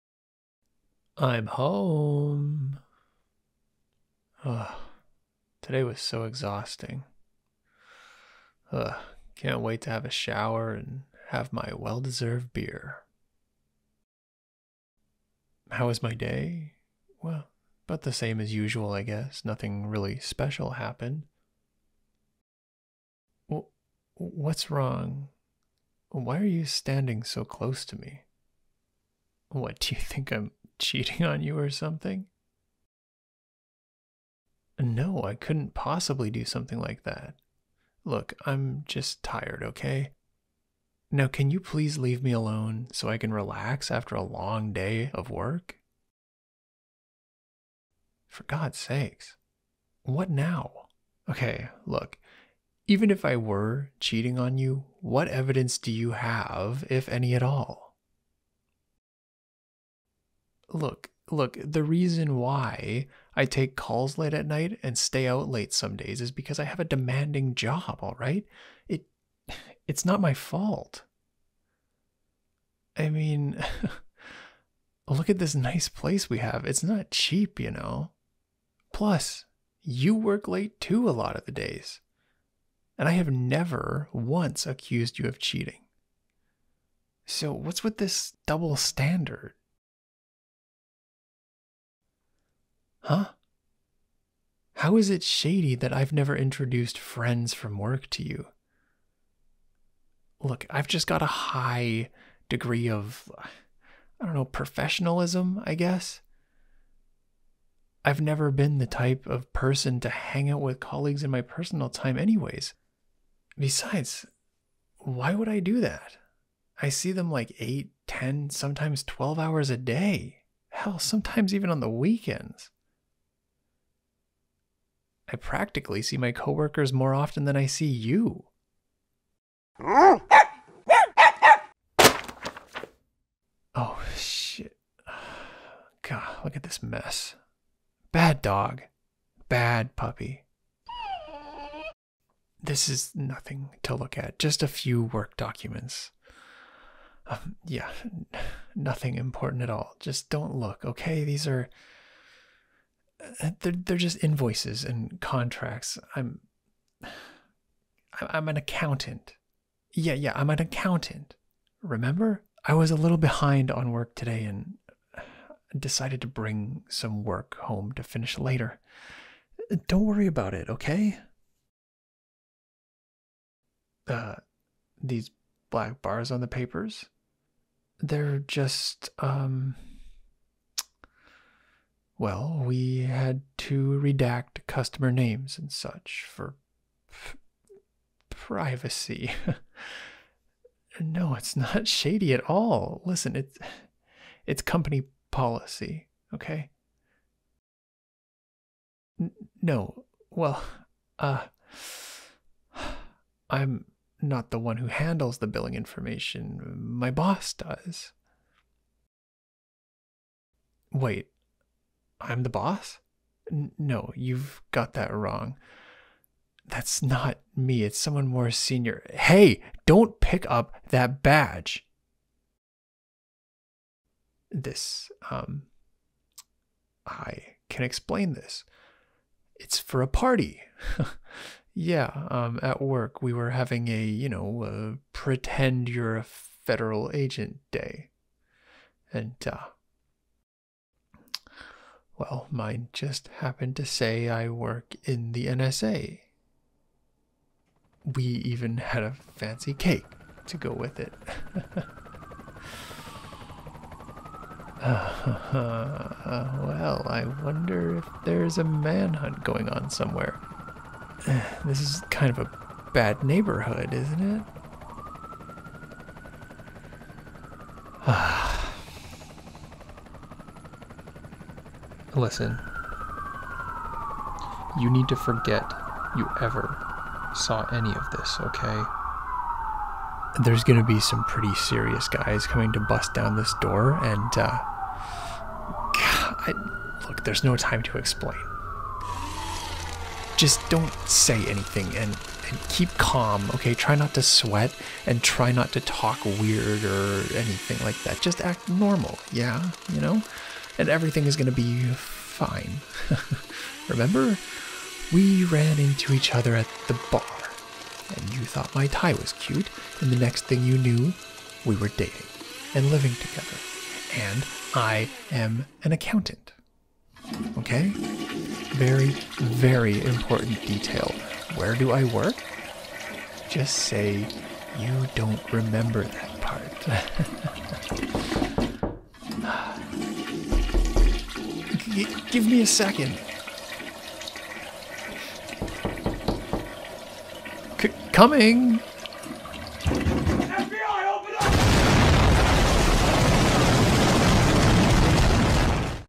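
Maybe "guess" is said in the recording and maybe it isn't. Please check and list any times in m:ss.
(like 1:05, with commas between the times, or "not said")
0:19, 1:45.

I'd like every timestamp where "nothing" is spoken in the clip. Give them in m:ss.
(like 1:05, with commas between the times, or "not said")
0:19, 2:23, 2:28.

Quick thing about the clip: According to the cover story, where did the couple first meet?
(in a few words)
At the bar.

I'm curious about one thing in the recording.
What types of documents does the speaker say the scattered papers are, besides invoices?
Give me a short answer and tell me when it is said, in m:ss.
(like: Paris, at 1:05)
Contracts, at 2:35.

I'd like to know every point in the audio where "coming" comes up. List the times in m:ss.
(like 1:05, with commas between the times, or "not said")
4:42, 5:38.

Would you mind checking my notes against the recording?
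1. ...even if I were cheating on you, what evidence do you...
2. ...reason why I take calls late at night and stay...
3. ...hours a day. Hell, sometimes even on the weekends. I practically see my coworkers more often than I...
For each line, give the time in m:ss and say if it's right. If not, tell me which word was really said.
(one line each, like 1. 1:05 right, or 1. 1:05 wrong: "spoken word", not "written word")
1. 0:52 right
2. 1:01 right
3. 1:59 right.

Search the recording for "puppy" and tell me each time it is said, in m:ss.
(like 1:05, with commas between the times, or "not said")
2:19.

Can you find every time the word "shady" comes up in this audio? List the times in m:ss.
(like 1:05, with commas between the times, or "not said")
1:35, 3:11.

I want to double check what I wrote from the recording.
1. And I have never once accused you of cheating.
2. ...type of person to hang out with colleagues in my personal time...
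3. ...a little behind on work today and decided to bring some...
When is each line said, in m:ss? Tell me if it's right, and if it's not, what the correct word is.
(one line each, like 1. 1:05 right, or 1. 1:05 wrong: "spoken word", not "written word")
1. 1:22 right
2. 1:48 right
3. 2:42 right.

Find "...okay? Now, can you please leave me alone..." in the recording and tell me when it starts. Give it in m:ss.
0:39.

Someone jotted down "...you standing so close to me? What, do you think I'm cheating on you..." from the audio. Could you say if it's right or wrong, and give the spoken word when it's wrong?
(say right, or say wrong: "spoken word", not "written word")
right.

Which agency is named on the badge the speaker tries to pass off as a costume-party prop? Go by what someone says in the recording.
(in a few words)
NSA.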